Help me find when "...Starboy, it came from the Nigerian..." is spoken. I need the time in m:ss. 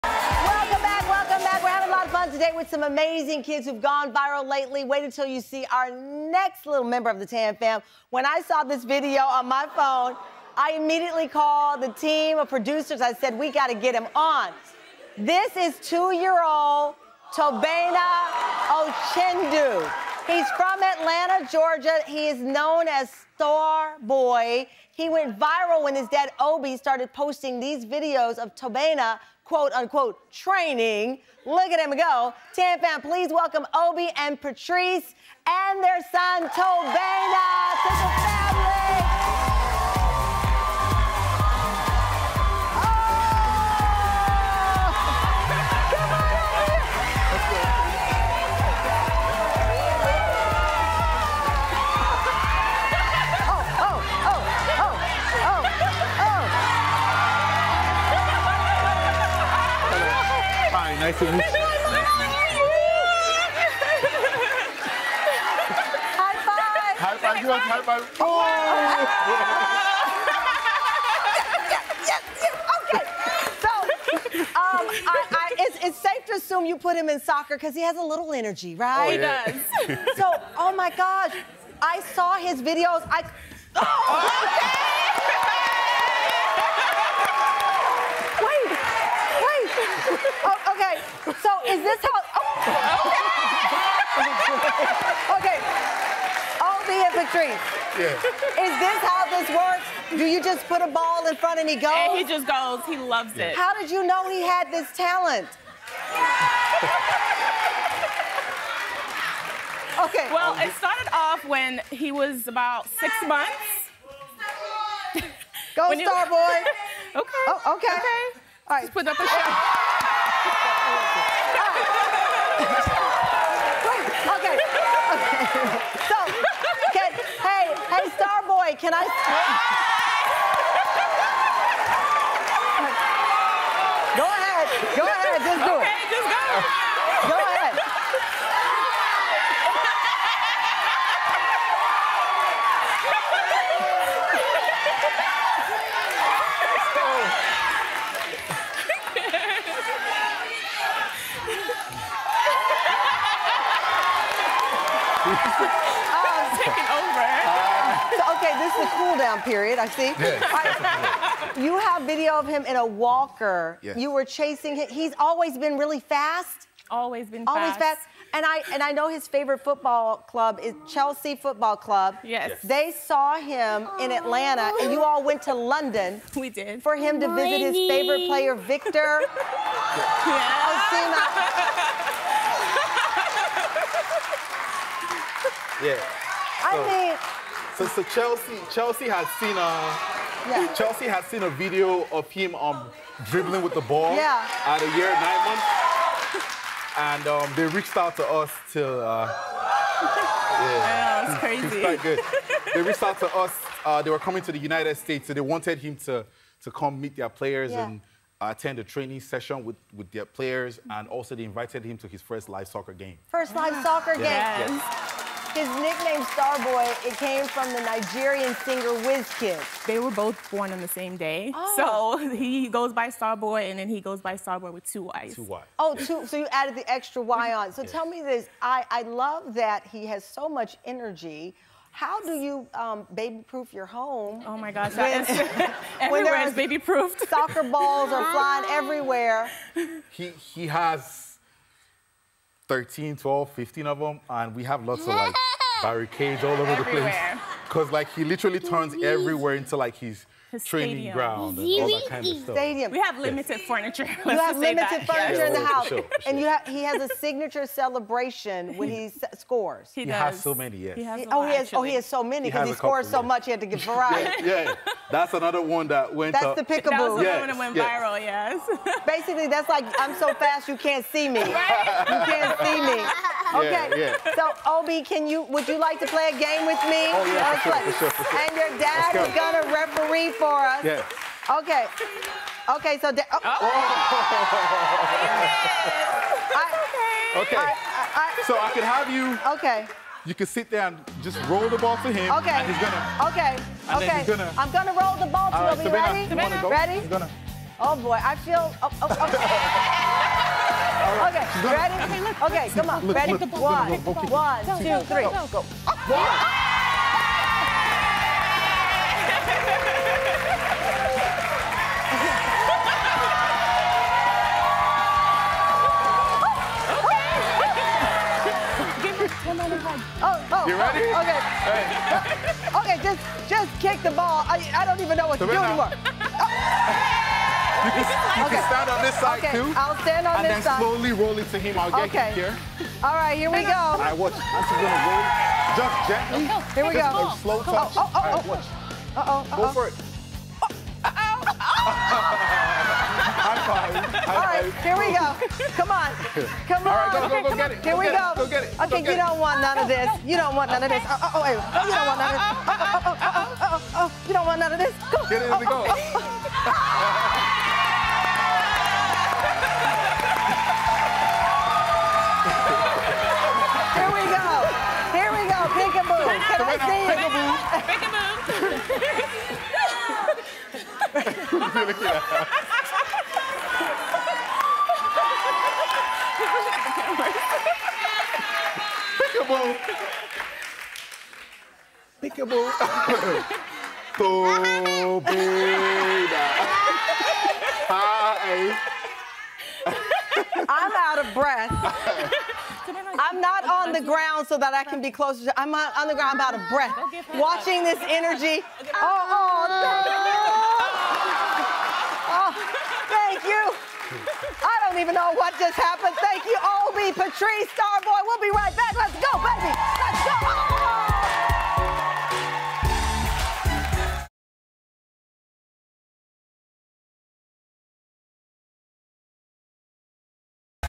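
3:36.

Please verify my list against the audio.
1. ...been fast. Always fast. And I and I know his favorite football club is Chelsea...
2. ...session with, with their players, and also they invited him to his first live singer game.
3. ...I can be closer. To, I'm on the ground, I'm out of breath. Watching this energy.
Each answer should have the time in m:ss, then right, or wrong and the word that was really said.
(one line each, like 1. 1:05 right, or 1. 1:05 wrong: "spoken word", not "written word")
1. 2:47 right
2. 3:29 wrong: "soccer", not "singer"
3. 6:34 right.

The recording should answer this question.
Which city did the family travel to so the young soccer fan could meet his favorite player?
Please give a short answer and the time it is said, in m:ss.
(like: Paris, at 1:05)
London, at 2:55.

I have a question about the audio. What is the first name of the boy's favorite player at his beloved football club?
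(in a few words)
Victor.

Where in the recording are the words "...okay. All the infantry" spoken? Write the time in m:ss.
1:35.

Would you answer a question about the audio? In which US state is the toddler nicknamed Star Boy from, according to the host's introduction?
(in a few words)
Georgia.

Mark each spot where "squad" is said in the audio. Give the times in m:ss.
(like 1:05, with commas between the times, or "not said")
not said.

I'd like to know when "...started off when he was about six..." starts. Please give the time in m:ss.
1:50.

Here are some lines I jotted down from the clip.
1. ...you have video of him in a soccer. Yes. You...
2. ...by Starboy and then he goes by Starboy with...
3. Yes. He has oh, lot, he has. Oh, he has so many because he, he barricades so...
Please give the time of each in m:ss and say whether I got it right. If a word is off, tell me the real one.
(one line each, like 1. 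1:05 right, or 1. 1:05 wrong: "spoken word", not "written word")
1. 2:41 wrong: "walker", not "soccer"
2. 3:42 right
3. 4:20 wrong: "scores", not "barricades".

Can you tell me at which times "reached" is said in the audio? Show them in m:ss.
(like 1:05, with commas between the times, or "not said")
3:17, 3:22.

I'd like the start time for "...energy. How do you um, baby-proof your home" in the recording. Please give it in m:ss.
3:50.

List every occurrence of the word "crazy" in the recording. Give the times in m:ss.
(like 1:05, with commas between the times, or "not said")
3:21.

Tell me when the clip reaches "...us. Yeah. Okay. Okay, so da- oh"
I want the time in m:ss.
4:40.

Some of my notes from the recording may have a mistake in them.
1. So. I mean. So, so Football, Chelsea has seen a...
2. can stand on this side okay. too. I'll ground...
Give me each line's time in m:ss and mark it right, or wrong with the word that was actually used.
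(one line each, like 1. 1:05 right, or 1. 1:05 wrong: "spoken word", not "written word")
1. 3:05 wrong: "Chelsea", not "Football"
2. 5:28 wrong: "stand", not "ground".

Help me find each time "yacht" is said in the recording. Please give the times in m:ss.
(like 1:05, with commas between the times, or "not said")
not said.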